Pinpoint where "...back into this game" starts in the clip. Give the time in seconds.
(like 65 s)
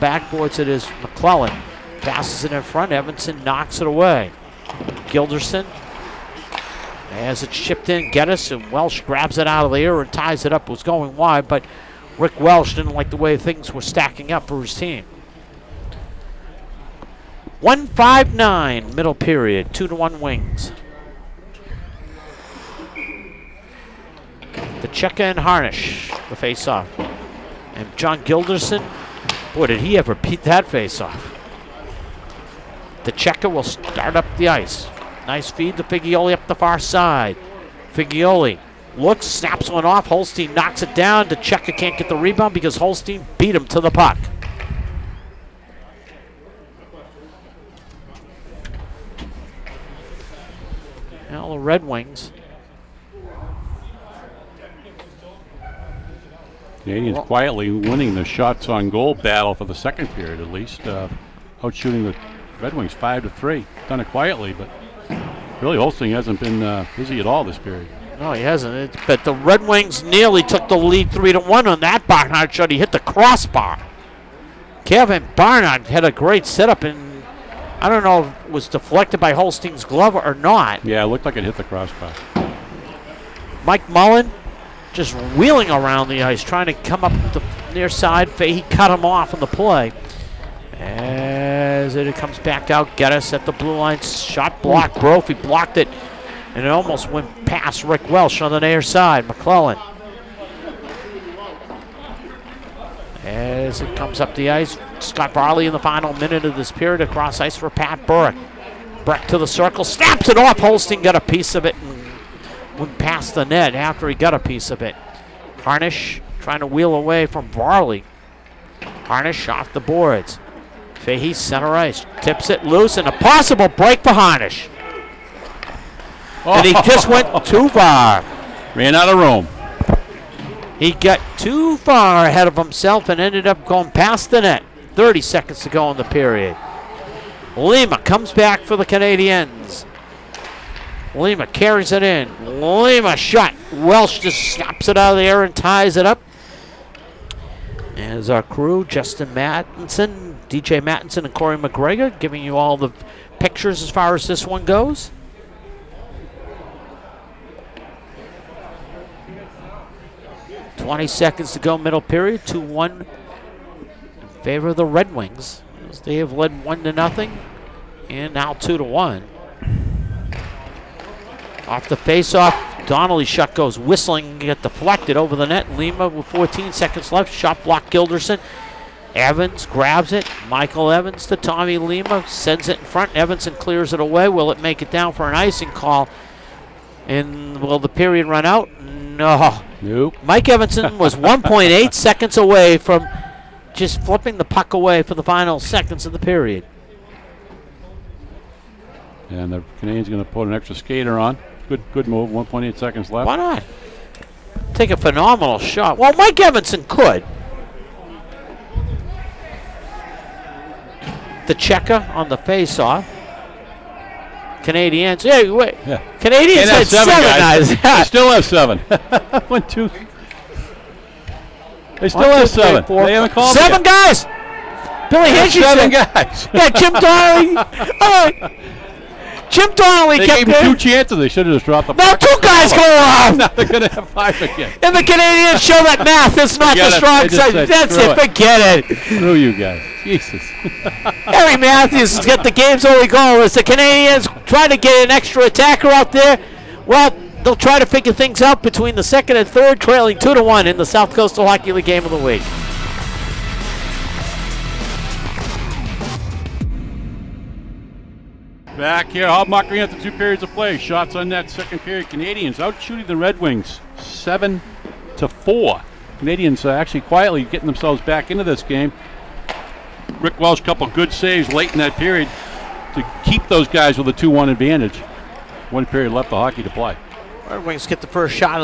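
268 s.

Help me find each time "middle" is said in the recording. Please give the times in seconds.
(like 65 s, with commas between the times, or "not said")
18 s, 161 s.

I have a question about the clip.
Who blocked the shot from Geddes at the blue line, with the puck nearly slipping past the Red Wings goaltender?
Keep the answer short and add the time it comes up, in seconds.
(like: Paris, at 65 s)
Brophy, at 94 s.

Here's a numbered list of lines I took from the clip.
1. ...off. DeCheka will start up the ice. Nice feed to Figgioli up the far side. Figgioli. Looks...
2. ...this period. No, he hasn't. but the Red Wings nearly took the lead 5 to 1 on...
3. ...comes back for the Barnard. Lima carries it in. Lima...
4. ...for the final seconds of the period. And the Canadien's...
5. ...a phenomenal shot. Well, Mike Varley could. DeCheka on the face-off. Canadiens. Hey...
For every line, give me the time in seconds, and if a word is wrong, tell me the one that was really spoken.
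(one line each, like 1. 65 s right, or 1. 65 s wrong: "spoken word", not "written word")
1. 31 s right
2. 67 s wrong: "3", not "5"
3. 137 s wrong: "Canadiens", not "Barnard"
4. 195 s right
5. 204 s wrong: "Evanson", not "Varley".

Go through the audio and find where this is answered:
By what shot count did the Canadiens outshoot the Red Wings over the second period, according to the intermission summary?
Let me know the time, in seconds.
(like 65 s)
263 s.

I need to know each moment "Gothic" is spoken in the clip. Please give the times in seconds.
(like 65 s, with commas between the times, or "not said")
not said.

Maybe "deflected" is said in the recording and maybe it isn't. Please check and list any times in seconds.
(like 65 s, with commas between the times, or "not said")
78 s, 174 s.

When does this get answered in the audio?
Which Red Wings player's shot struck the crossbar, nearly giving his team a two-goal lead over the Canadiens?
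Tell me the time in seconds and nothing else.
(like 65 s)
74 s.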